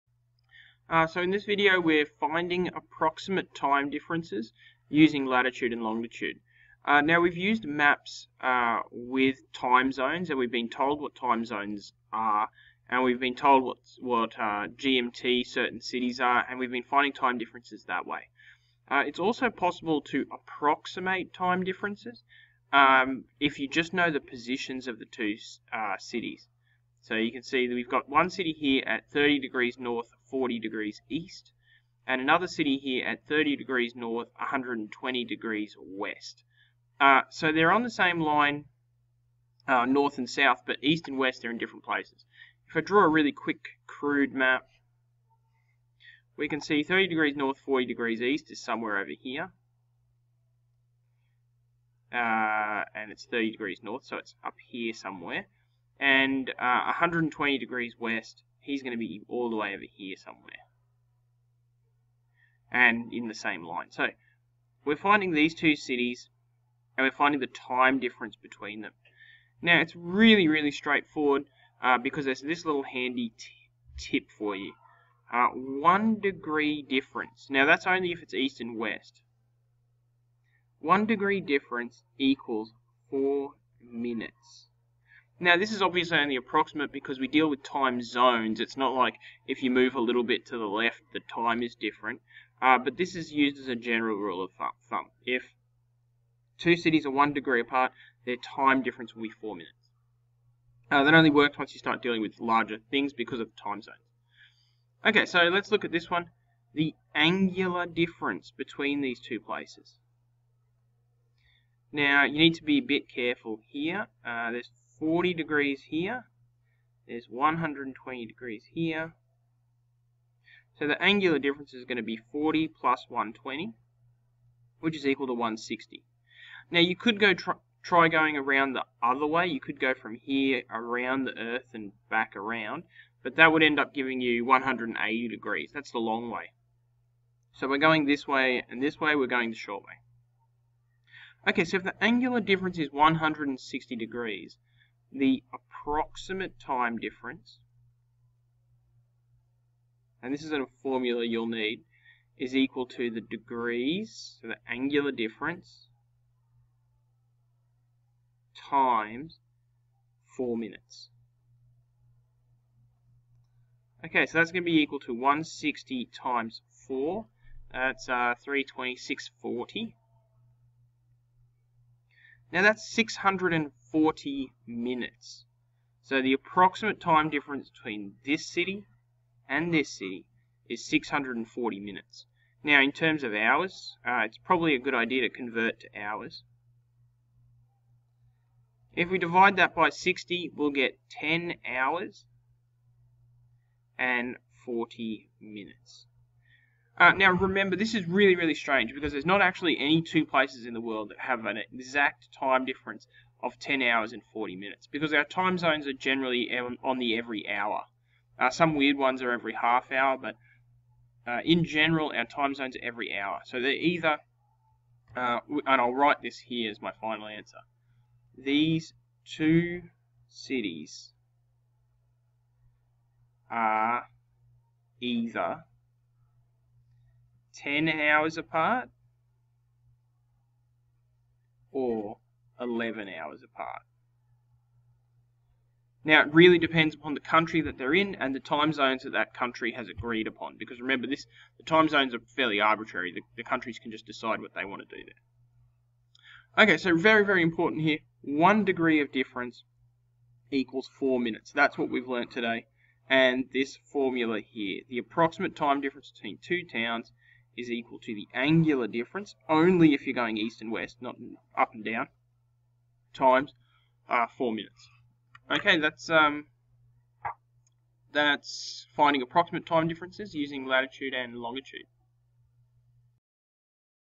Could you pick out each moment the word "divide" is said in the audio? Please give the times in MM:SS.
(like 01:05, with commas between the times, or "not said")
03:09.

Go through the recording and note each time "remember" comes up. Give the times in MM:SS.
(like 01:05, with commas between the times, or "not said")
03:17, 04:00.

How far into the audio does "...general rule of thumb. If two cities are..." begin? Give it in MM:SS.
01:33.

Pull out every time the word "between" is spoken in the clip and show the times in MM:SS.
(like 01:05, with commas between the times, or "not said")
01:08, 01:48, 02:57, 04:16.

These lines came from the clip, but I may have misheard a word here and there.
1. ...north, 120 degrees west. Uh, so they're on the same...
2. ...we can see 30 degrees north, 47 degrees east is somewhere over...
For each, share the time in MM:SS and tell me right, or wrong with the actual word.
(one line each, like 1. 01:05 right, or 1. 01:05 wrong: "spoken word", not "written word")
1. 00:33 right
2. 00:46 wrong: "40", not "47".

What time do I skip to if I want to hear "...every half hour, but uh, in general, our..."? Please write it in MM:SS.
03:29.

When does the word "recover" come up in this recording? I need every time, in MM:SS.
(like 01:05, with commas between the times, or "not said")
not said.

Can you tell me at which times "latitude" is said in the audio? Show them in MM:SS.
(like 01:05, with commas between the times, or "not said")
00:05, 04:30.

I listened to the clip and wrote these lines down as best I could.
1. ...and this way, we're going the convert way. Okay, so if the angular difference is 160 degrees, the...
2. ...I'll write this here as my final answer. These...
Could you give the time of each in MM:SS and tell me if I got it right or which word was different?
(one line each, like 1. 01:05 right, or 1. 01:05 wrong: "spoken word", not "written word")
1. 02:18 wrong: "short", not "convert"
2. 03:35 right.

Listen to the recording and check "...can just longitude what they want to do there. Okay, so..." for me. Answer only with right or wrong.
wrong.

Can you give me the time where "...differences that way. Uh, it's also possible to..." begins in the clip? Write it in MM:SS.
00:17.